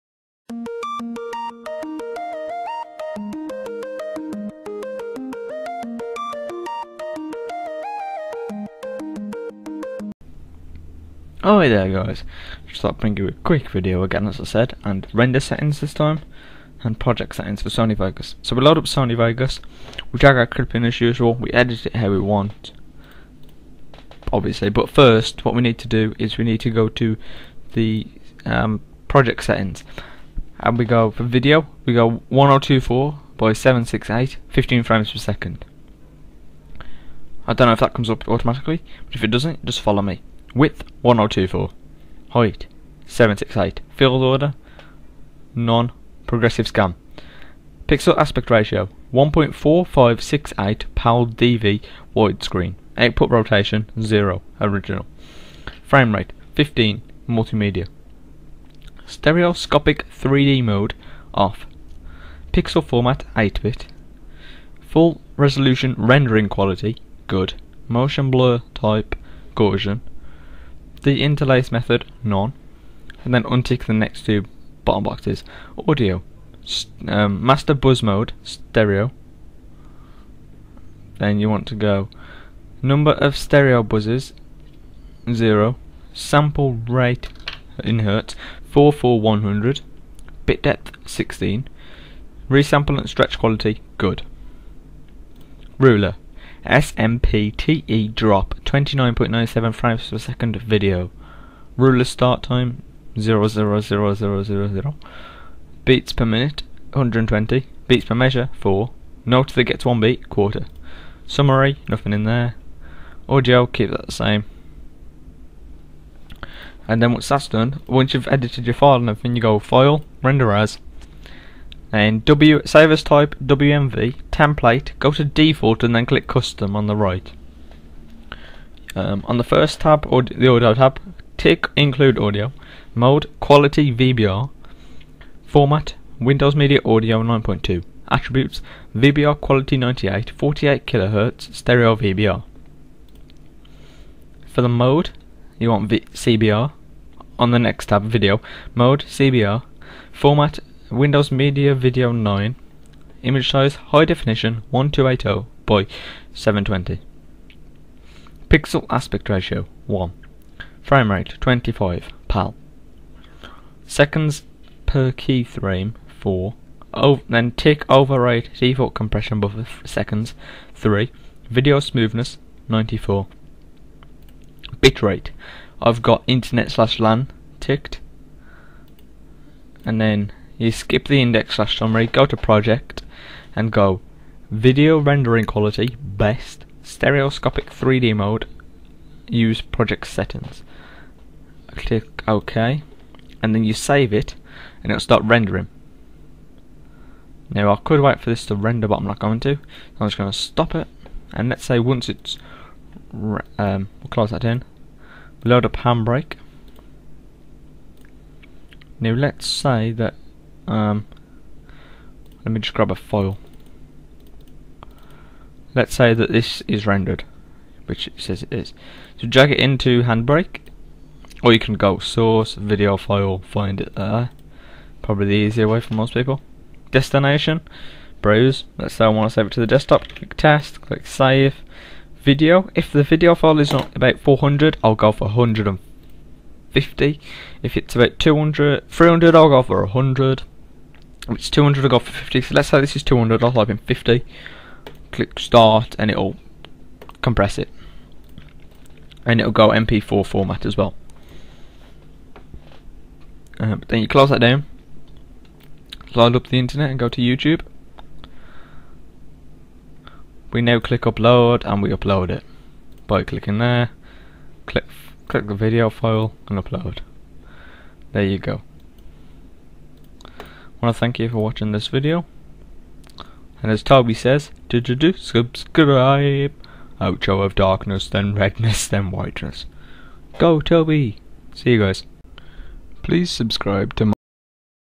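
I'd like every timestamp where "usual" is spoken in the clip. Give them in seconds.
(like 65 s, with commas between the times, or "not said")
21 s.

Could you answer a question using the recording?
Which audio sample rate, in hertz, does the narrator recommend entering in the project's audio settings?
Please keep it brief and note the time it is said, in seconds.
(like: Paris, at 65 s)
44100, at 88 s.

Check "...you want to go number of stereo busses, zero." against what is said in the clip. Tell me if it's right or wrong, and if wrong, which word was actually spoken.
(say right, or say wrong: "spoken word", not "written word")
right.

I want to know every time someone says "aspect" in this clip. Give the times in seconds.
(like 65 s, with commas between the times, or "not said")
48 s, 158 s.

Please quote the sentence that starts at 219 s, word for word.
So drag it into Handbrake, or you can go source, video file, find it there.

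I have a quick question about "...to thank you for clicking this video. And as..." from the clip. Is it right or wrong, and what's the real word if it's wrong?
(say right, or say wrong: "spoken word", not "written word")
wrong: "watching", not "clicking".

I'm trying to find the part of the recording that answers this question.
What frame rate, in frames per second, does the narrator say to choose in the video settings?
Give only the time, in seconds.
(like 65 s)
34 s.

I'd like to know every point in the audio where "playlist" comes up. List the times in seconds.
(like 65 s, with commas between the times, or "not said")
not said.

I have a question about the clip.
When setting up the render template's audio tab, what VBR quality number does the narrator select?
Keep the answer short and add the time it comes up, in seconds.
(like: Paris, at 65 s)
98, at 138 s.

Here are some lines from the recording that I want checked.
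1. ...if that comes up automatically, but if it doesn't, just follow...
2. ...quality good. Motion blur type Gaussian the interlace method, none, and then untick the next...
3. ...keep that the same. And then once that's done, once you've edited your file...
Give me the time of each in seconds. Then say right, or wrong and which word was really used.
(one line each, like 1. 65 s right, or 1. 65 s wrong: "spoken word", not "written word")
1. 37 s right
2. 66 s right
3. 113 s right.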